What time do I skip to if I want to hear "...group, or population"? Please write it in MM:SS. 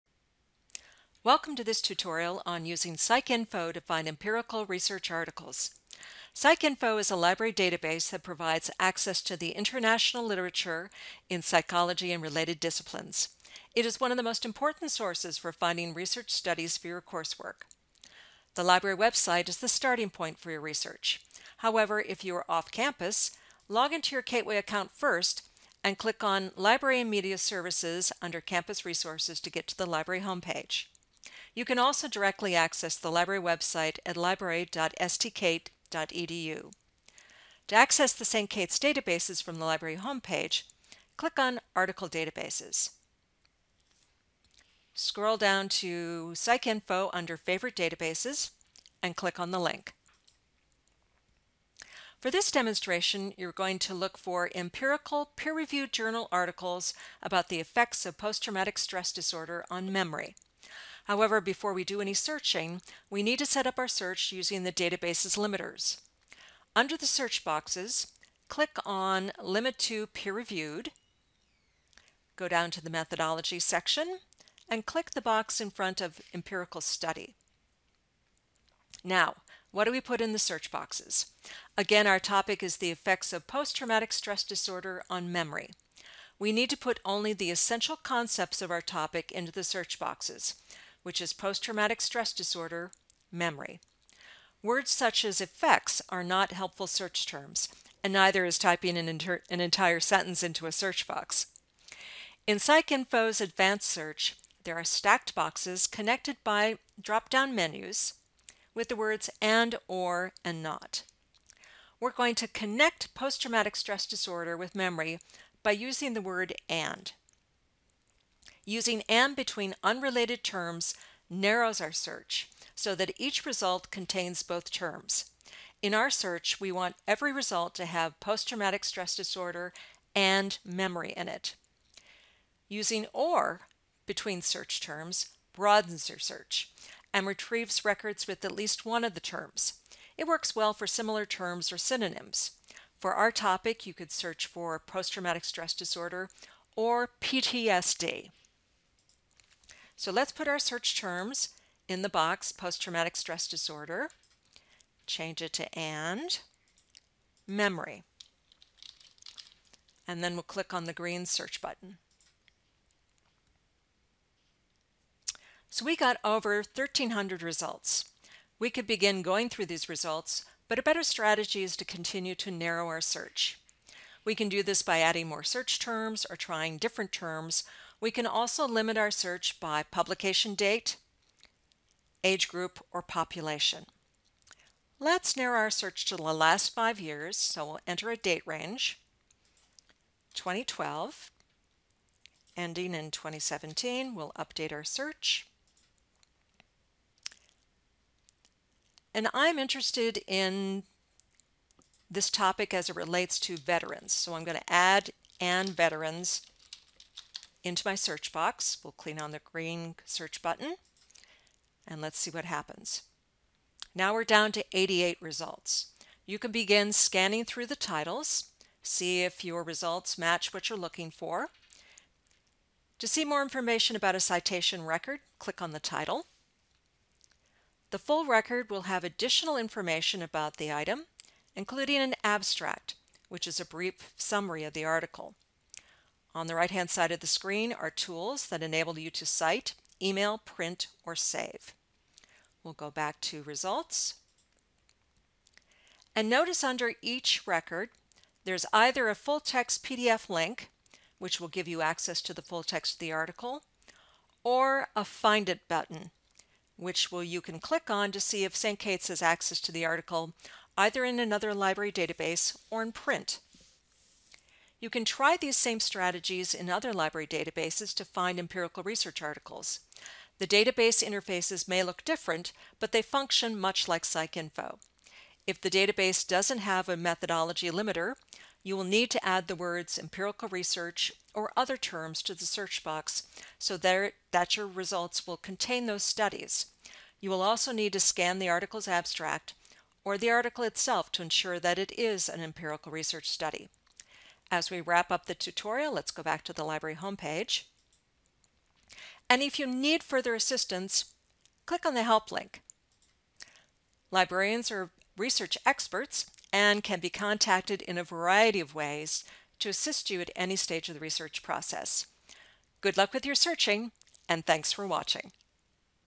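03:02.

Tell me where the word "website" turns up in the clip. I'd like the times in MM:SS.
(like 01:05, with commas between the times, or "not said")
00:18, 00:33.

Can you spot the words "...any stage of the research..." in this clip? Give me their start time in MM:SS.
05:10.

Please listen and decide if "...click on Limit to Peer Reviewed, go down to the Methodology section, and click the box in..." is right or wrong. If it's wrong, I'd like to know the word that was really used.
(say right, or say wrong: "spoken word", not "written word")
right.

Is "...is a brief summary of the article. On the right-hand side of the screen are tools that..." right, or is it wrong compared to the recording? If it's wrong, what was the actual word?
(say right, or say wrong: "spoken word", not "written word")
right.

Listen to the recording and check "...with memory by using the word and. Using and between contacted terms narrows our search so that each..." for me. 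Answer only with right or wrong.
wrong.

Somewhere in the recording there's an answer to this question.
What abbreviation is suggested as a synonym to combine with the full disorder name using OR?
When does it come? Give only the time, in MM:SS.
02:27.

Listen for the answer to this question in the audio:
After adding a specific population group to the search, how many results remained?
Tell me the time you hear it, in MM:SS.
03:34.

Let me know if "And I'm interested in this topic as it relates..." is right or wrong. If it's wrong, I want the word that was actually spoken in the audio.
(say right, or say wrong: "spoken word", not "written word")
right.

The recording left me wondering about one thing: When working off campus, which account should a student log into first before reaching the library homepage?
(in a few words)
Kateway.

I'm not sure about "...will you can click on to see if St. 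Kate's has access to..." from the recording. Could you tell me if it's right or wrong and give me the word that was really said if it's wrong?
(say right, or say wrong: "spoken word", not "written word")
right.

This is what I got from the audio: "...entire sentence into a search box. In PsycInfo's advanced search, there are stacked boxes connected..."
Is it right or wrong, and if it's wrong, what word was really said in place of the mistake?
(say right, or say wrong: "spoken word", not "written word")
right.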